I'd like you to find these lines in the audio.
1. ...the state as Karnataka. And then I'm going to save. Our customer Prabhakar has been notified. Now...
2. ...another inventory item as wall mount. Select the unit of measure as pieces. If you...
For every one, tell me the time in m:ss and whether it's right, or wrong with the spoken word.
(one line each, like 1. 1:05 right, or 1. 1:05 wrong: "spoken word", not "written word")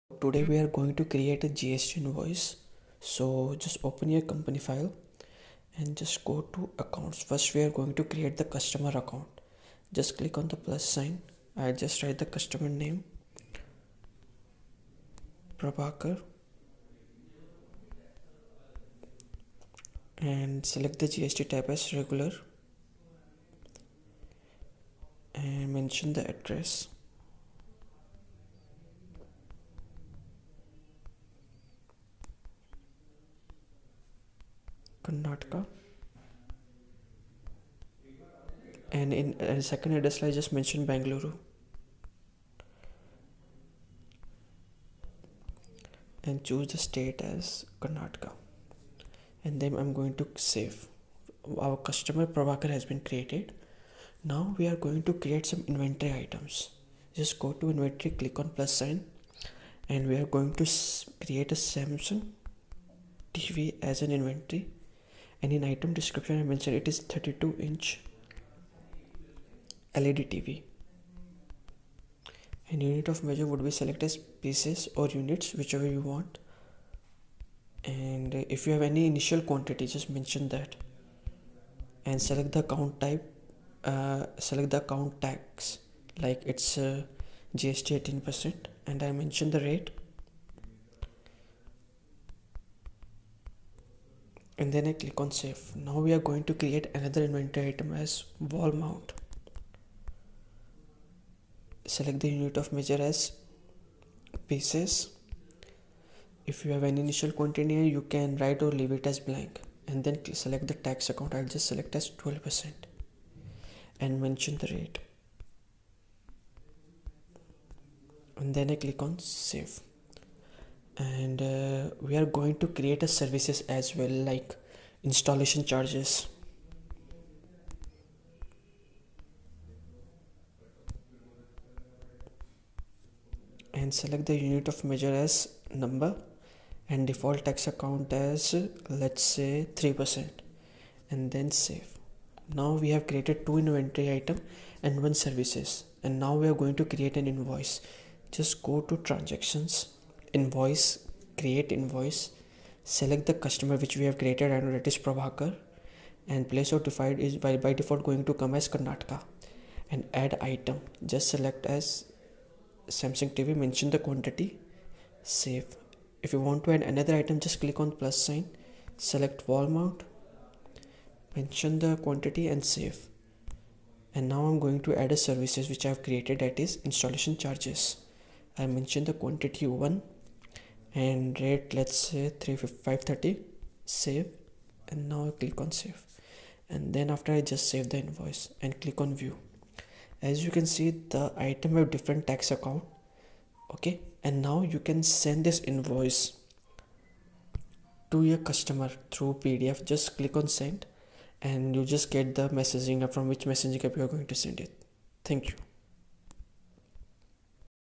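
1. 0:46 wrong: "created", not "notified"
2. 1:36 right.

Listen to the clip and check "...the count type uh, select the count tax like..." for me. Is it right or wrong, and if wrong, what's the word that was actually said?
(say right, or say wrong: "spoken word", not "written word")
right.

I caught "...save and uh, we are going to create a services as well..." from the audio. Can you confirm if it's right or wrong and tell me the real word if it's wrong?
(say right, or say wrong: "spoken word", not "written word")
right.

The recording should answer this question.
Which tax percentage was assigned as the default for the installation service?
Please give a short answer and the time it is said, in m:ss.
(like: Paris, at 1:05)
3%, at 2:19.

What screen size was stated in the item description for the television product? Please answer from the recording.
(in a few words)
32 inch.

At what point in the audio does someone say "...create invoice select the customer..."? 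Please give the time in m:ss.
2:31.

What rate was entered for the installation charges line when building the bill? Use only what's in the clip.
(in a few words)
350.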